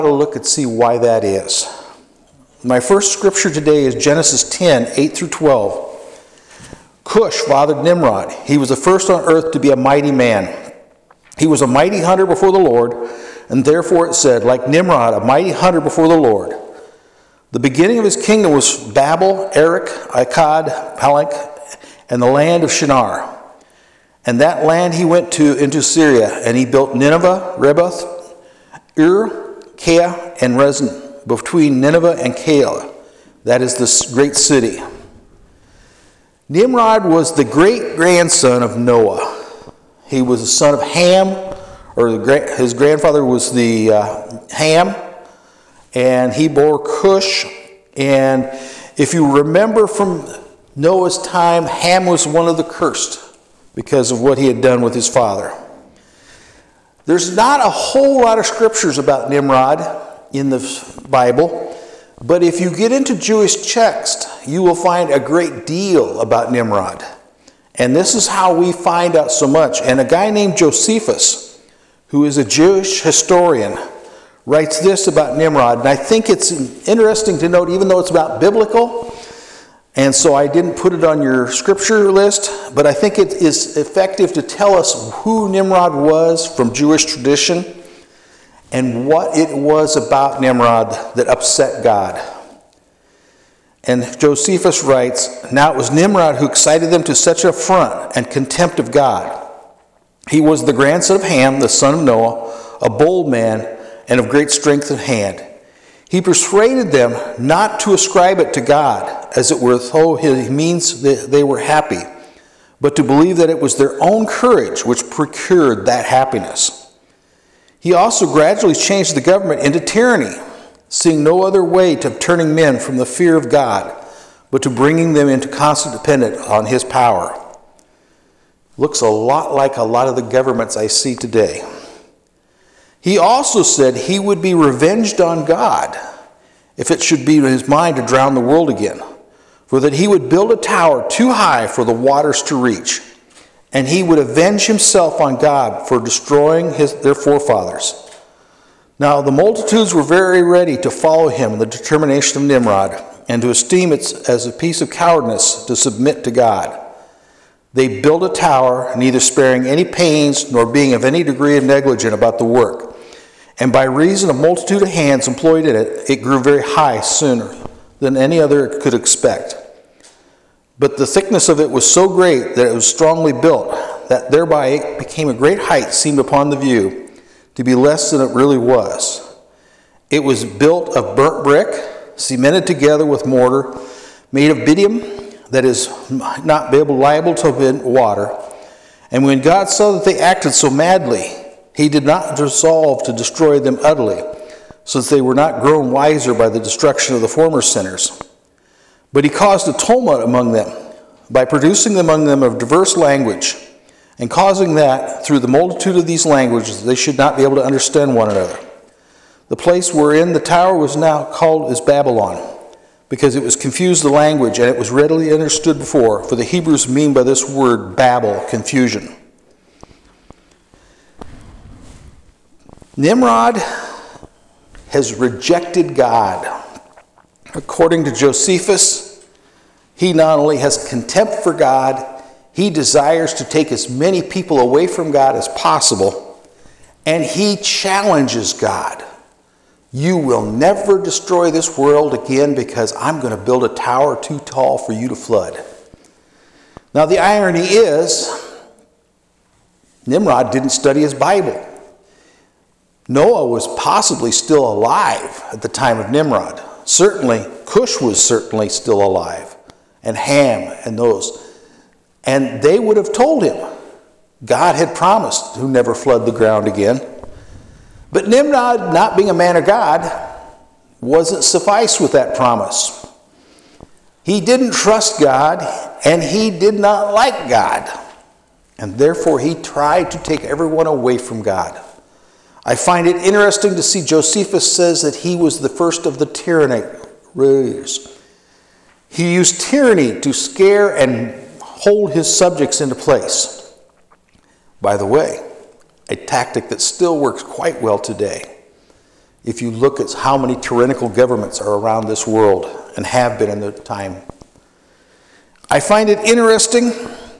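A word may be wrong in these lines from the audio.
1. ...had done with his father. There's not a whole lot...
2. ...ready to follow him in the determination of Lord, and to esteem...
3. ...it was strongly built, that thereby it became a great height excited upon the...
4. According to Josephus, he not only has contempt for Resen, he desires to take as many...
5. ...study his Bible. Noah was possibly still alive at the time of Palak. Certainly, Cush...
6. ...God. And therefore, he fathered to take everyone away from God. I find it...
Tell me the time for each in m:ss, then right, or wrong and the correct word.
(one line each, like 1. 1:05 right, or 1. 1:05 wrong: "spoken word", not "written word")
1. 0:54 right
2. 2:30 wrong: "Nimrod", not "Lord"
3. 2:52 wrong: "seemed", not "excited"
4. 3:47 wrong: "God", not "Resen"
5. 4:10 wrong: "Nimrod", not "Palak"
6. 4:37 wrong: "tried", not "fathered".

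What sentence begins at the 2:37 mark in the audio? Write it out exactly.
They built a tower, neither sparing any pains nor being of any degree negligent about the work.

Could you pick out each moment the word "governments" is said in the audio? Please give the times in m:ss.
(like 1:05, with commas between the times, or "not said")
1:59, 2:10, 5:01.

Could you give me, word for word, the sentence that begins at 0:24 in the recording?
And that land he went to into Syria, and he built Nineveh, Reboth, Ur, Kea, and Resen, between Nineveh and Kea.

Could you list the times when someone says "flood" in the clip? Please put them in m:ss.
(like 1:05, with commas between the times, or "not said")
4:05, 4:25.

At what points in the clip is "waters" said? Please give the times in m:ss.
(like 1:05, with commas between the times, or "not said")
2:21, 3:07.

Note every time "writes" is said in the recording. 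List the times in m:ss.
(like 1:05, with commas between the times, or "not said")
1:14, 1:34.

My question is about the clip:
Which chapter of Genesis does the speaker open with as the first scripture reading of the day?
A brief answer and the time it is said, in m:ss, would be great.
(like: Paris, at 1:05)
10, at 0:03.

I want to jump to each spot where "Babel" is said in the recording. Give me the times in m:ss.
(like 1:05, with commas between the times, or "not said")
0:18, 3:37.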